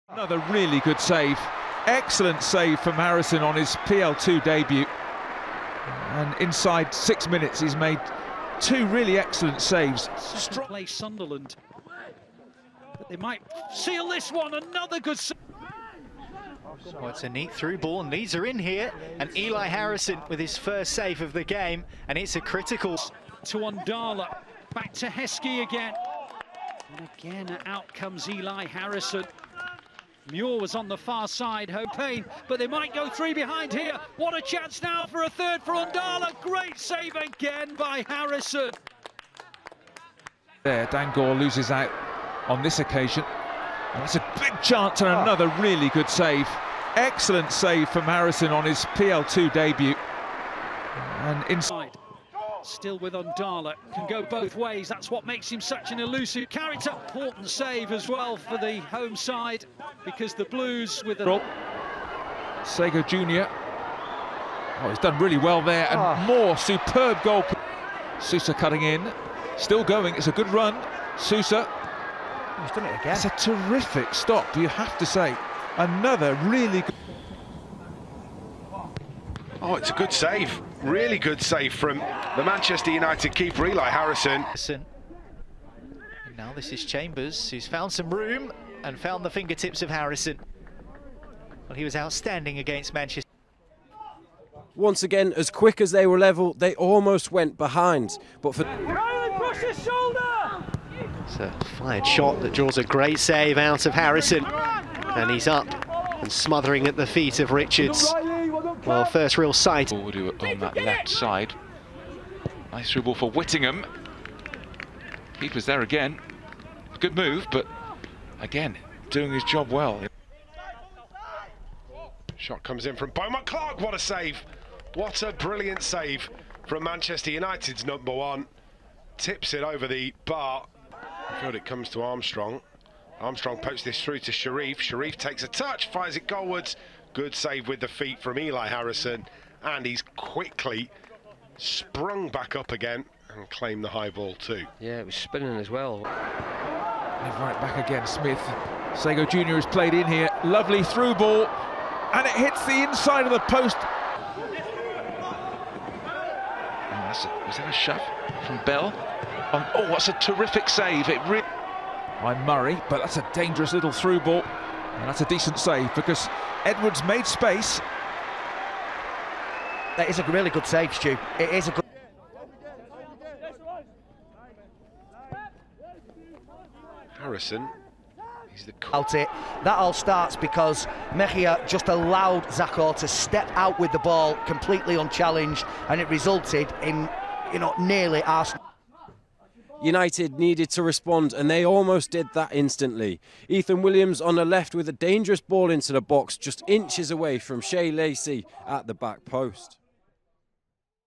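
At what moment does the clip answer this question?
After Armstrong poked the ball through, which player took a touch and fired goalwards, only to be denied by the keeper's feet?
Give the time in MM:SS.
02:14.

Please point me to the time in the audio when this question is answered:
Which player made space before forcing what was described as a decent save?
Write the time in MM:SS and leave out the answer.
02:46.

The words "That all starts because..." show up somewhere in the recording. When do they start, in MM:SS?
02:59.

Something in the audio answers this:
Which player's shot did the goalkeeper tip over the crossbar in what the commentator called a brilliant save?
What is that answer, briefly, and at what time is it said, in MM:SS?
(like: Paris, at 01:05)
Beaumont Clark, at 02:03.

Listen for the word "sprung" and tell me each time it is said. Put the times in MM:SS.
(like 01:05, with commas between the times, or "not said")
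02:21.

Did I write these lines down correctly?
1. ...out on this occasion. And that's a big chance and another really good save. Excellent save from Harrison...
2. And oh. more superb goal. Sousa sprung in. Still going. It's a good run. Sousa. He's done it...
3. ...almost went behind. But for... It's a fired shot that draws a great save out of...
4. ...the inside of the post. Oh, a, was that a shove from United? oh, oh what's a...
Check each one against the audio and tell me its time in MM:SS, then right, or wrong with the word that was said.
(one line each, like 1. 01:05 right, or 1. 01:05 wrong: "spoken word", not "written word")
1. 00:41 right
2. 01:05 wrong: "cutting", not "sprung"
3. 01:36 right
4. 02:32 wrong: "Bell", not "United".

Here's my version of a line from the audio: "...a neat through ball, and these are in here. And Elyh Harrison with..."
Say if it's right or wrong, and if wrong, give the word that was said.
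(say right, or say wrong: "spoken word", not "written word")
right.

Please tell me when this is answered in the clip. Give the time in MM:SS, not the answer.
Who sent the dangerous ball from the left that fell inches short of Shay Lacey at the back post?
03:13.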